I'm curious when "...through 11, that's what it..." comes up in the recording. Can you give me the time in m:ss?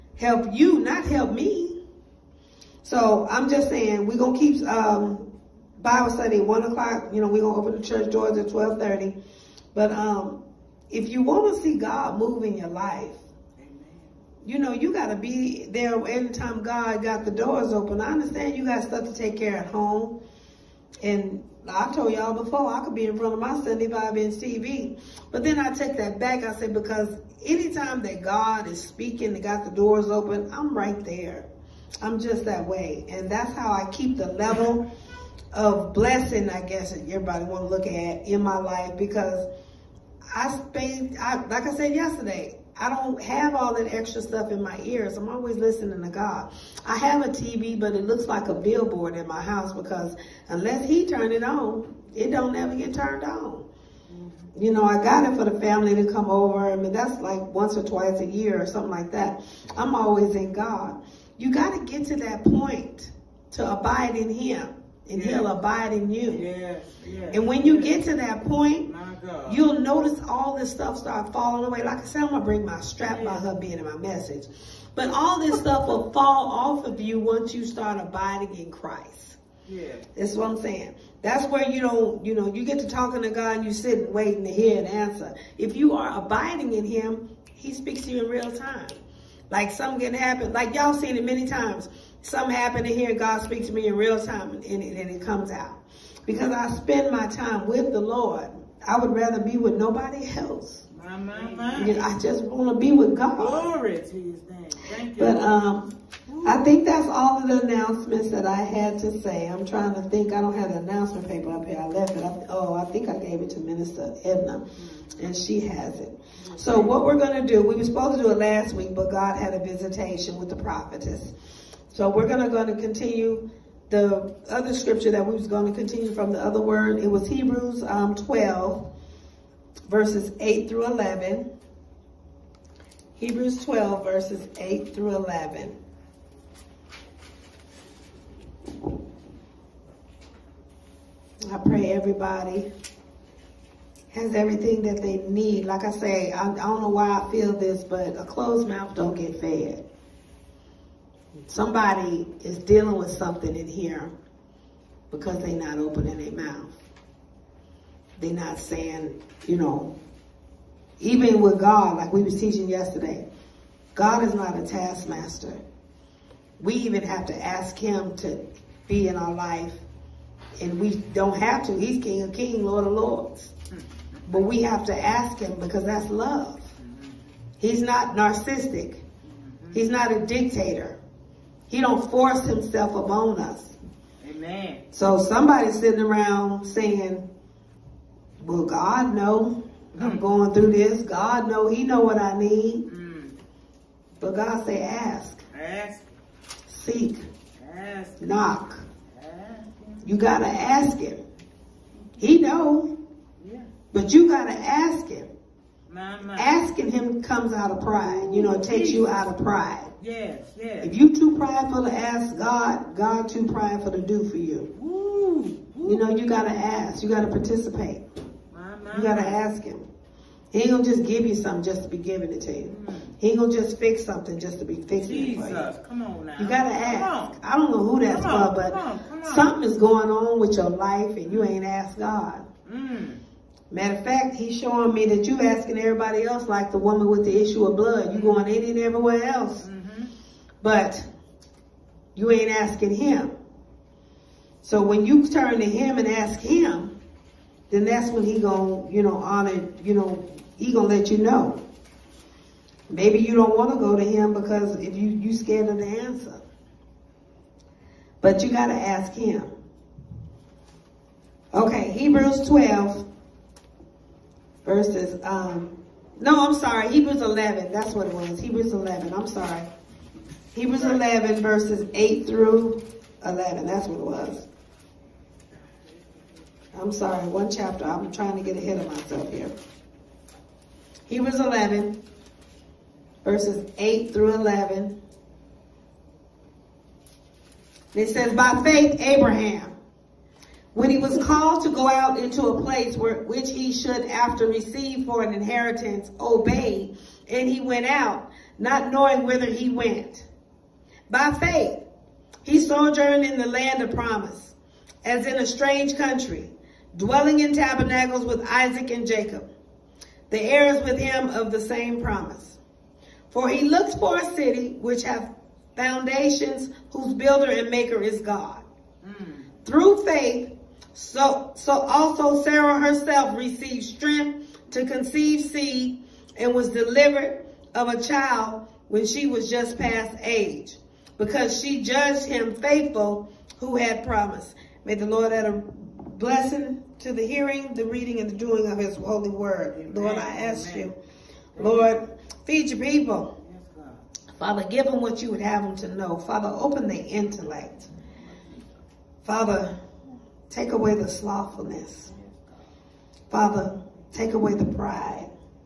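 4:32.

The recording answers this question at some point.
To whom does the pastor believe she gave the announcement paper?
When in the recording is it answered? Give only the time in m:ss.
1:53.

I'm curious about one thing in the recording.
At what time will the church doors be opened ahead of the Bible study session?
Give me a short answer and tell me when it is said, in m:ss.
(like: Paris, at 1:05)
12:30, at 0:08.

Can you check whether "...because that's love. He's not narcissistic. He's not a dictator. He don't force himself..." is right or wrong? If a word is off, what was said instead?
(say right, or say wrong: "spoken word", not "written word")
right.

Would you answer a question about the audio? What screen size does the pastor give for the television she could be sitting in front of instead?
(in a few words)
75 inch.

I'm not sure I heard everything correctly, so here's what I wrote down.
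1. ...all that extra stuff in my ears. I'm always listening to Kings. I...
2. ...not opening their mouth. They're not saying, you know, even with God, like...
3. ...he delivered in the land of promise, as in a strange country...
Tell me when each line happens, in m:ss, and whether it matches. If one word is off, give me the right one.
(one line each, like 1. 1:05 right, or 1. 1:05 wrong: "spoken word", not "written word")
1. 0:43 wrong: "God", not "Kings"
2. 2:35 right
3. 5:02 wrong: "sojourned", not "delivered".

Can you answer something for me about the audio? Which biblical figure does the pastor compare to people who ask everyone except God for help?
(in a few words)
the woman with the issue of blood.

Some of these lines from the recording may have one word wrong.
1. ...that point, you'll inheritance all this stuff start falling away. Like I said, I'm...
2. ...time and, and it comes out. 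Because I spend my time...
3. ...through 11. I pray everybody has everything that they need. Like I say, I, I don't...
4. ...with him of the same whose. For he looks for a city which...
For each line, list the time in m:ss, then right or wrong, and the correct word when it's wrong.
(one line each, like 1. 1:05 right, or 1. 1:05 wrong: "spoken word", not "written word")
1. 1:08 wrong: "notice", not "inheritance"
2. 1:34 right
3. 2:14 right
4. 5:10 wrong: "promise", not "whose".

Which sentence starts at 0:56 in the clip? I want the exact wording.
I mean, that's like once or twice a year or something like that.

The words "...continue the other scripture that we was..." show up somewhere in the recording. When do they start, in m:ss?
2:02.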